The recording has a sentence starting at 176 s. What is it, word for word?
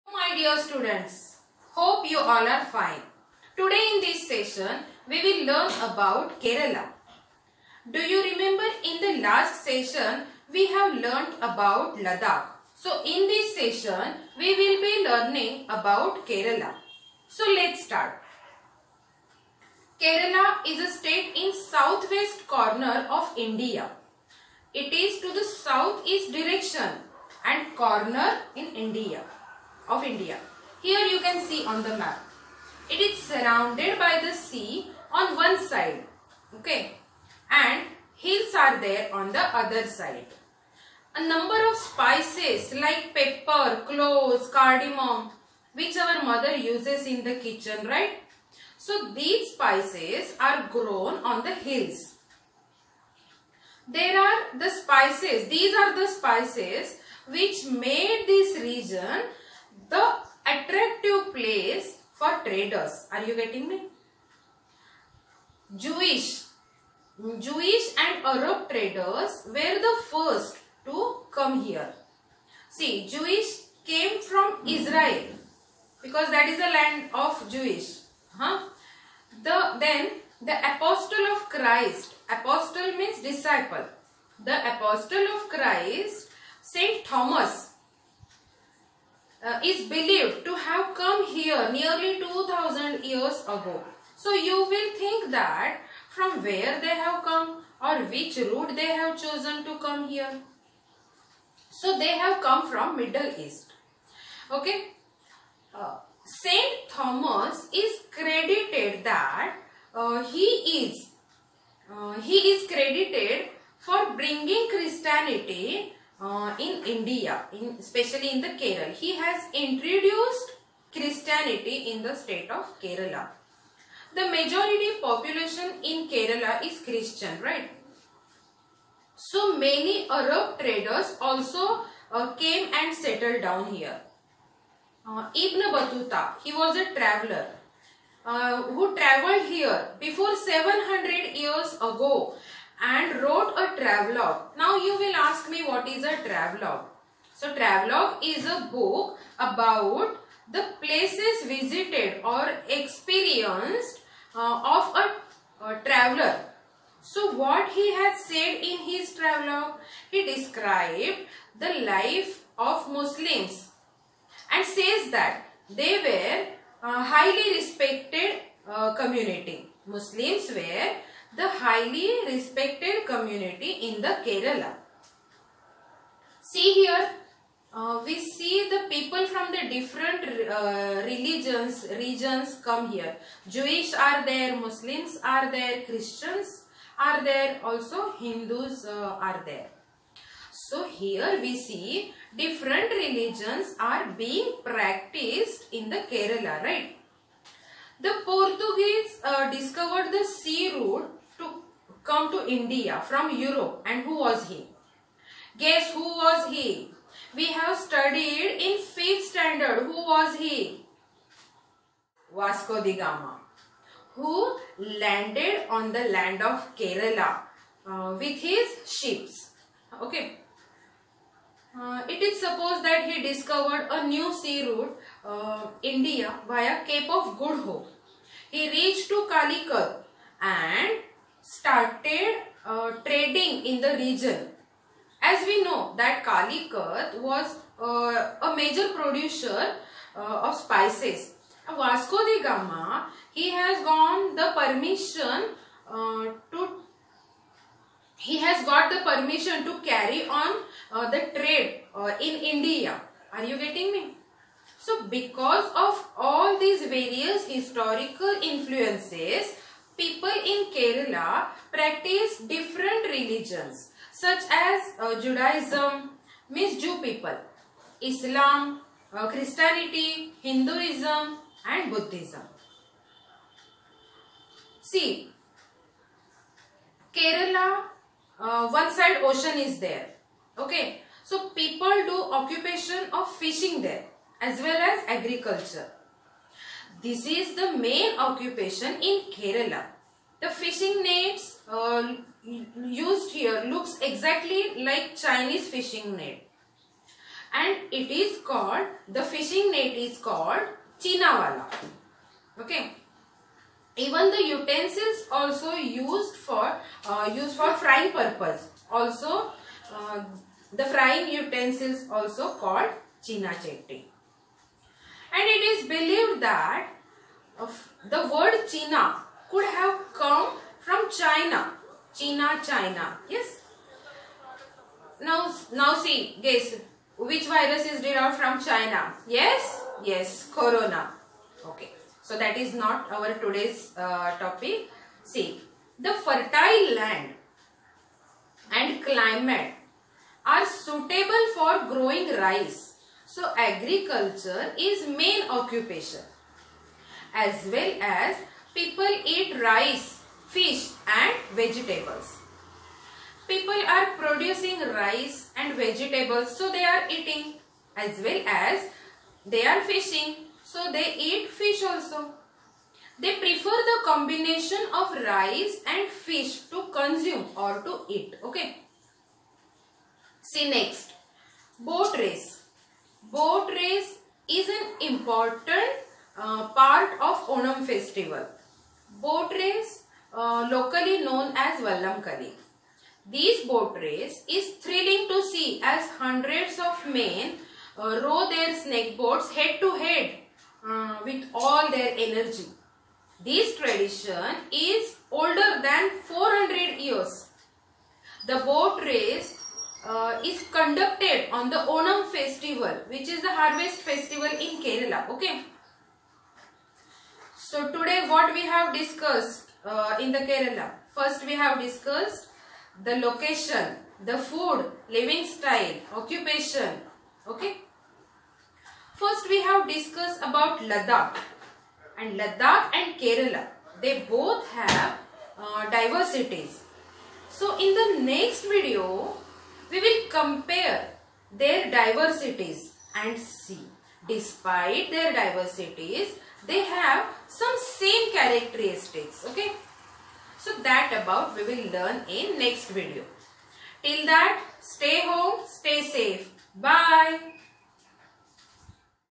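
See here, uh, we see the people from the different uh, religions, regions come here.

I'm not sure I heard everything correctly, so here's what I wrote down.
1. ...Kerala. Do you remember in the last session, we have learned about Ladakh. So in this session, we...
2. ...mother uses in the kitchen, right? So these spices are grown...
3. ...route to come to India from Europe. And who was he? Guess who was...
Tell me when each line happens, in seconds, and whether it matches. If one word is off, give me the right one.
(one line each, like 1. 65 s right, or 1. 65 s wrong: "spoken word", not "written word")
1. 6 s right
2. 46 s right
3. 200 s right.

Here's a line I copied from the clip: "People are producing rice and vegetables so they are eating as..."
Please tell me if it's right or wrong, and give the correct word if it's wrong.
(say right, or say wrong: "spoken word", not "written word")
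right.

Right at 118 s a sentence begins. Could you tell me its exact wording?
He has introduced Christianity in the state of Kerala.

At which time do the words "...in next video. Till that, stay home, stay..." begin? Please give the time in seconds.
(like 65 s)
442 s.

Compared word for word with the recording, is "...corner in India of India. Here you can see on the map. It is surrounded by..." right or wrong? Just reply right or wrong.
right.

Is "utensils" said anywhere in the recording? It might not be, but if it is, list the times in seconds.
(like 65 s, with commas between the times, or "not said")
304 s, 311 s.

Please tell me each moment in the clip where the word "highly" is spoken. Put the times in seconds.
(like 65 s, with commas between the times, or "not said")
167 s, 171 s.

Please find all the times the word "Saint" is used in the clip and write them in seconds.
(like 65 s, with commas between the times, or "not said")
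86 s, 106 s.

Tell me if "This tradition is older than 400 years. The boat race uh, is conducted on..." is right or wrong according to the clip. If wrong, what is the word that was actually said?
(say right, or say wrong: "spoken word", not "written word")
right.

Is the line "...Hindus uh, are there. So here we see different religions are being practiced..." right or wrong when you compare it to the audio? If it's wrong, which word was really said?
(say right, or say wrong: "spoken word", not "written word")
right.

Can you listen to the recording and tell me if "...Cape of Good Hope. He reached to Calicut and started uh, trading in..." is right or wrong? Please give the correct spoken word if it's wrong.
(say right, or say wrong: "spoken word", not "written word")
right.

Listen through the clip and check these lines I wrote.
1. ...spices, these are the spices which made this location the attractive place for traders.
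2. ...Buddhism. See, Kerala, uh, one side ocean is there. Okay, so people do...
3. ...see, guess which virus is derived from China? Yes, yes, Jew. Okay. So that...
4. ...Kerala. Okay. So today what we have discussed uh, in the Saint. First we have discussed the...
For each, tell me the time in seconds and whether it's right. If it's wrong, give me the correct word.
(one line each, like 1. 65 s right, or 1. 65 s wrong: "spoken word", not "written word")
1. 54 s wrong: "region", not "location"
2. 271 s right
3. 325 s wrong: "Corona", not "Jew"
4. 404 s wrong: "Kerala", not "Saint".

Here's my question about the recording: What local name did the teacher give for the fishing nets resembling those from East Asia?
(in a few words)
Chinawala.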